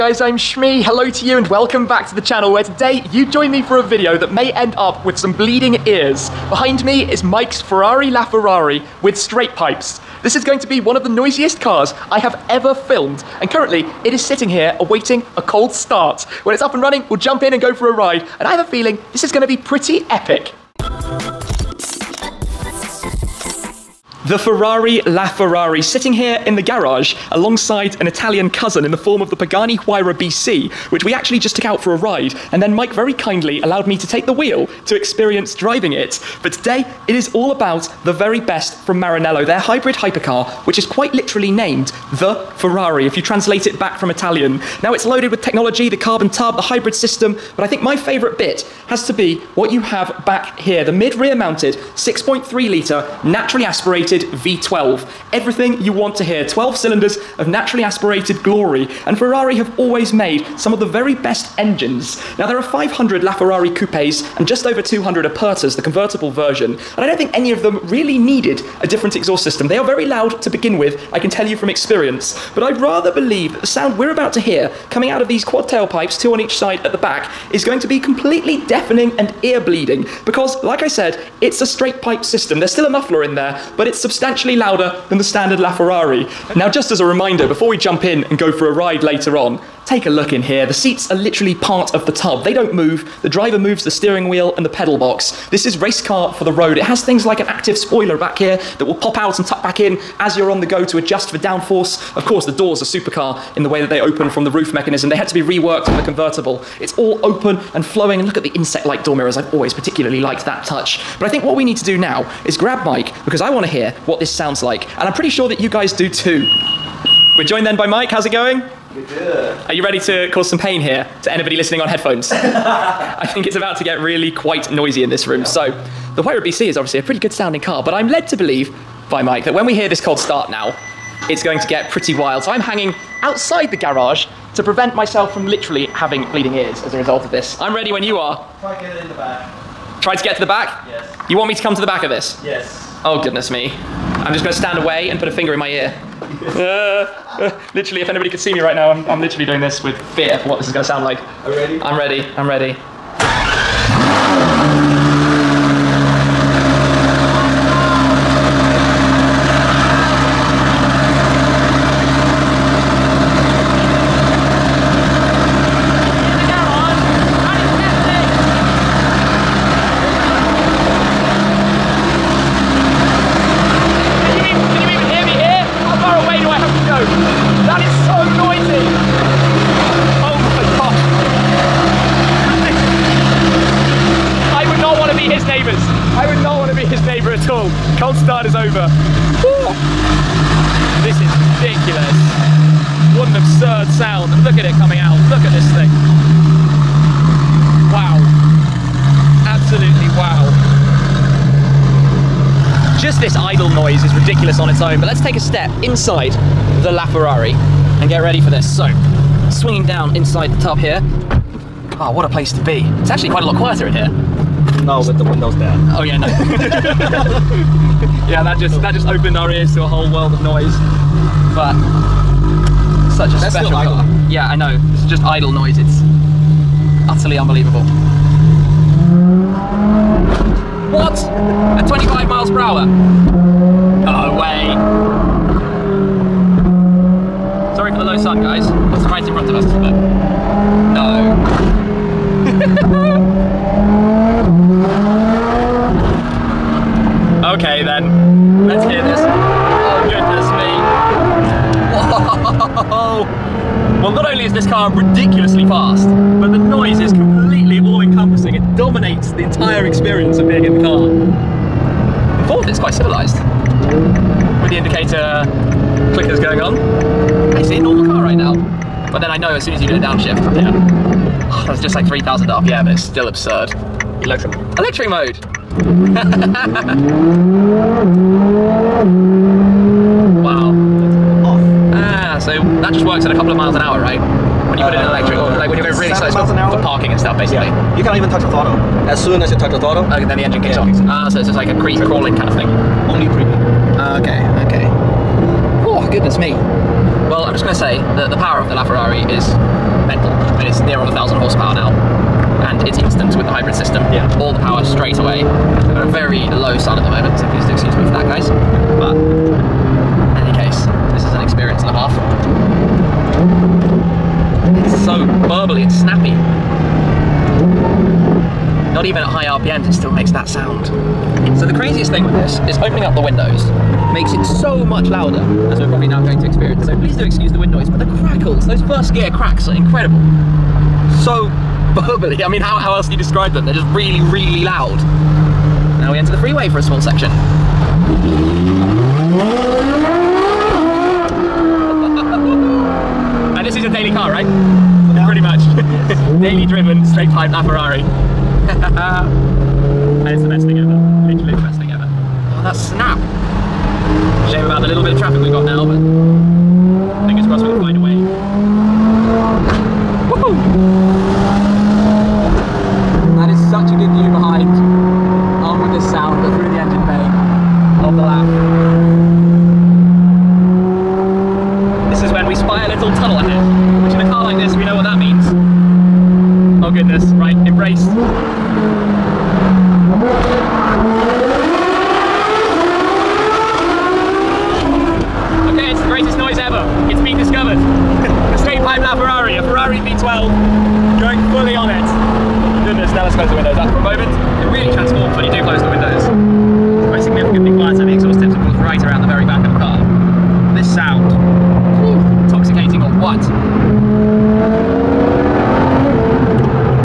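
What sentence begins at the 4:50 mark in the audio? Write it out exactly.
kicks Ah, so it's just like a creep crawling kind of thing.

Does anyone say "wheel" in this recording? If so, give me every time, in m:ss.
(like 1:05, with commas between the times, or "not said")
0:34, 1:34.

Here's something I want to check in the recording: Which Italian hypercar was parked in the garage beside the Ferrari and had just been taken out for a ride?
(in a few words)
Pagani Huayra BC.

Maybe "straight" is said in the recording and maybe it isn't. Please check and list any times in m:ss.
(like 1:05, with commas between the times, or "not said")
0:09, 1:21, 5:04, 5:47.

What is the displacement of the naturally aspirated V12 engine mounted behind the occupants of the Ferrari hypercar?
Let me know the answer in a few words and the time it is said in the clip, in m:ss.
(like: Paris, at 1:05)
6.3 litre, at 0:51.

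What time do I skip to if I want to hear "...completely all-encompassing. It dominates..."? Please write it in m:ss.
4:17.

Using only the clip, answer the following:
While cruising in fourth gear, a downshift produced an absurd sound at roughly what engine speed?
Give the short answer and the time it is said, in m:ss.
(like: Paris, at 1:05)
3,000 RPM, at 4:32.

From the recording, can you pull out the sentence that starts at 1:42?
Of course, the doors are supercar in the way that they open from the roof mechanism.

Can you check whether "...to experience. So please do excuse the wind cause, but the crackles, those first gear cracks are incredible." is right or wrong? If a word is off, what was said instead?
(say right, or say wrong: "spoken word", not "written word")
wrong: "noise", not "cause".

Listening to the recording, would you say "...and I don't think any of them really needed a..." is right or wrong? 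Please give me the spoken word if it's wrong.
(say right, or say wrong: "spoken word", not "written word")
right.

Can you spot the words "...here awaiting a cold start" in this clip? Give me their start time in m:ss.
0:14.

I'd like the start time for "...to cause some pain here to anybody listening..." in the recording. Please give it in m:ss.
1:59.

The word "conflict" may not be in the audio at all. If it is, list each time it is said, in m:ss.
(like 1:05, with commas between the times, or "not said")
not said.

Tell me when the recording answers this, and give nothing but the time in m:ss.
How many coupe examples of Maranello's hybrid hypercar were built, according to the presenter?
1:02.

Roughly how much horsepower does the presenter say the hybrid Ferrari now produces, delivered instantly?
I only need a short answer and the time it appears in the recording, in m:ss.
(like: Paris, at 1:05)
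1,000 horsepower, at 5:01.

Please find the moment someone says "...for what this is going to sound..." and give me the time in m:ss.
2:30.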